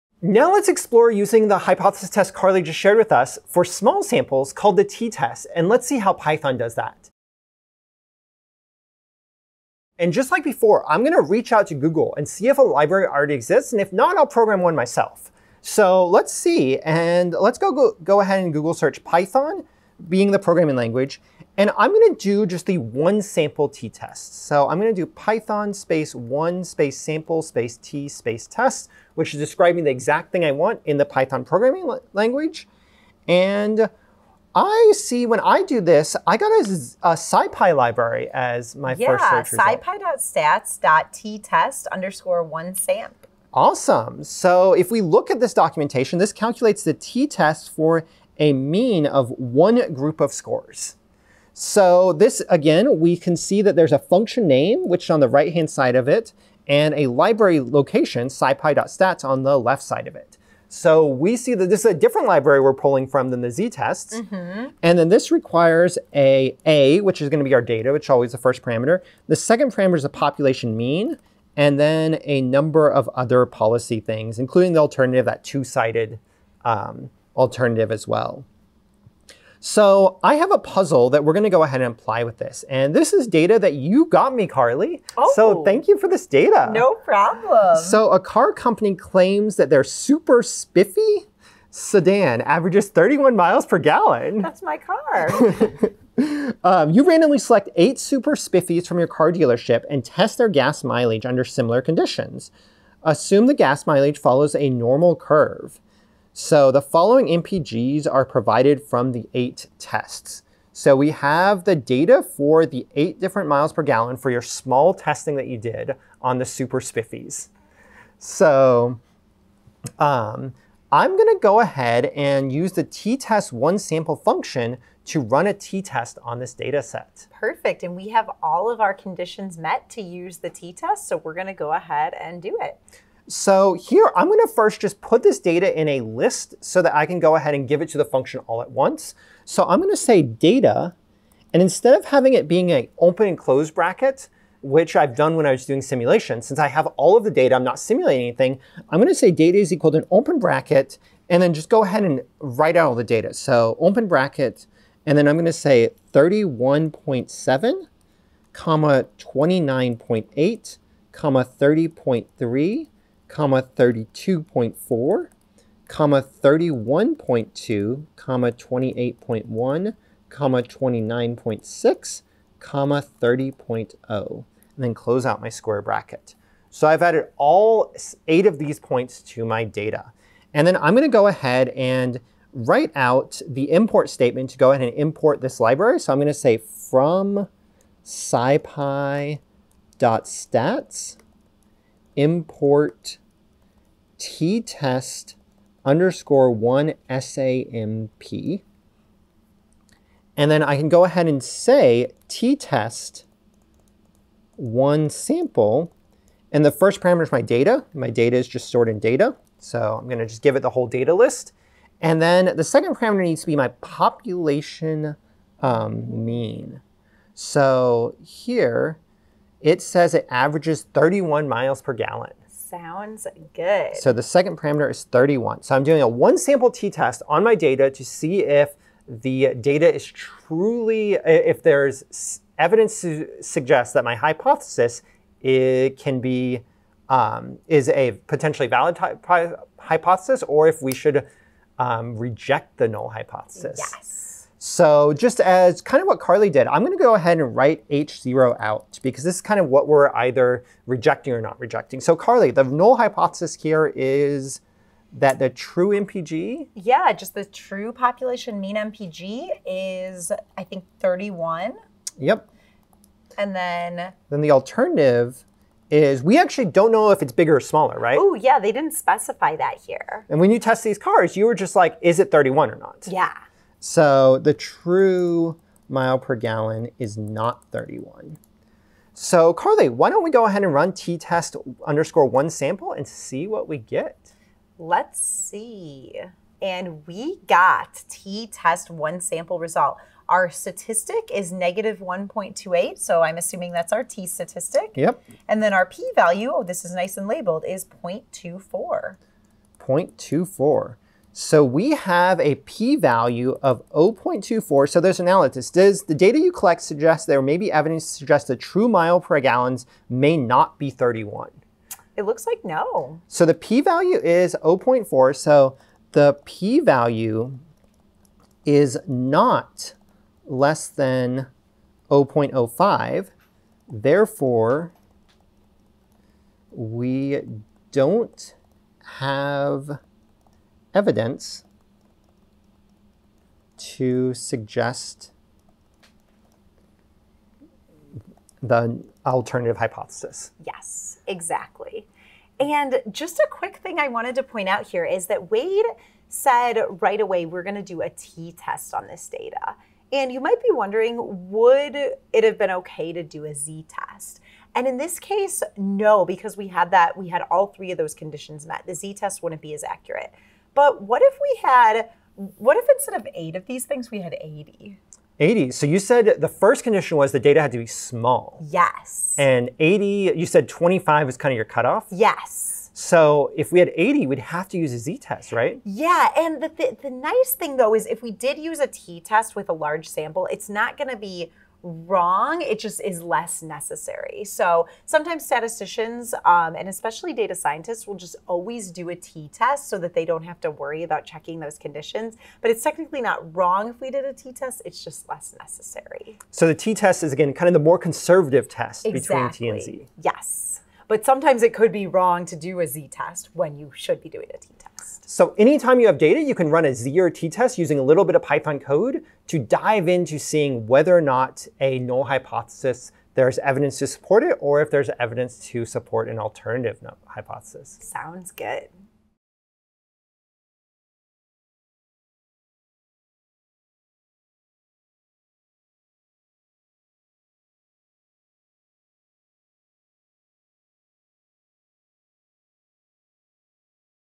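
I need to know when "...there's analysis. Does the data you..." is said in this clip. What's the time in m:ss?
5:04.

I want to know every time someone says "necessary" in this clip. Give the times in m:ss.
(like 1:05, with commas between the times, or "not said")
6:23, 6:35.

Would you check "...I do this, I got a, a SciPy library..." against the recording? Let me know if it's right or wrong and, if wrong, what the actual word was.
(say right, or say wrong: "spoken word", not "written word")
right.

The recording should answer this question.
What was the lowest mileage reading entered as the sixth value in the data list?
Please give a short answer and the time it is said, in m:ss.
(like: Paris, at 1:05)
28.1, at 2:48.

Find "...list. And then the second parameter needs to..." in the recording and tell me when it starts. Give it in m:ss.
3:31.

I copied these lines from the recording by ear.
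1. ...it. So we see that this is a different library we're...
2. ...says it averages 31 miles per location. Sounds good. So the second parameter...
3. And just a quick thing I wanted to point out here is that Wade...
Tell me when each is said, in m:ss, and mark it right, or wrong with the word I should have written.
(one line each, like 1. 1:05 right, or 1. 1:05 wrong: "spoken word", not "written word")
1. 1:00 right
2. 3:39 wrong: "gallon", not "location"
3. 5:42 right.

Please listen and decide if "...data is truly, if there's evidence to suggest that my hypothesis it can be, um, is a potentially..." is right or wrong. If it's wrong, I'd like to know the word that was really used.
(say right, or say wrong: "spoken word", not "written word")
right.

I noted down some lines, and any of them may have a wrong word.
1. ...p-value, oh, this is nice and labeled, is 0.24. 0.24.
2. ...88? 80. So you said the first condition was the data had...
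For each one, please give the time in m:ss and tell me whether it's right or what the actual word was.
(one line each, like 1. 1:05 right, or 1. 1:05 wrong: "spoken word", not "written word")
1. 4:55 right
2. 6:04 wrong: "80", not "88".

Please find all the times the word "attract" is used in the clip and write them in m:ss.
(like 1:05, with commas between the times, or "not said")
not said.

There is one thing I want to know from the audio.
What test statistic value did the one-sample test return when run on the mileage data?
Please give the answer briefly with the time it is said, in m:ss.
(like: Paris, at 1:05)
-1.28, at 4:51.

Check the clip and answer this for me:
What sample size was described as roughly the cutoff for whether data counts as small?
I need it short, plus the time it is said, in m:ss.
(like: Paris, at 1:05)
25, at 6:10.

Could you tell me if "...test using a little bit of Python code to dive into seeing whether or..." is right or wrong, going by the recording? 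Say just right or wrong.
right.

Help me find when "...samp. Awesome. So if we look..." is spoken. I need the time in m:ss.
0:42.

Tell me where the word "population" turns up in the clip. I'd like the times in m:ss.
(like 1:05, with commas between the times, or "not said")
1:10, 3:33, 4:17.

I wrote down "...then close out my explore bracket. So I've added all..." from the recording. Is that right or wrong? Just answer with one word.
wrong.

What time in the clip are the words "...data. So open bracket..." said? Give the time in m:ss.
2:33.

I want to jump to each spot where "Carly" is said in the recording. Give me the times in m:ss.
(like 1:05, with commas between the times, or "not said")
0:02, 1:24, 4:06, 4:12, 4:39.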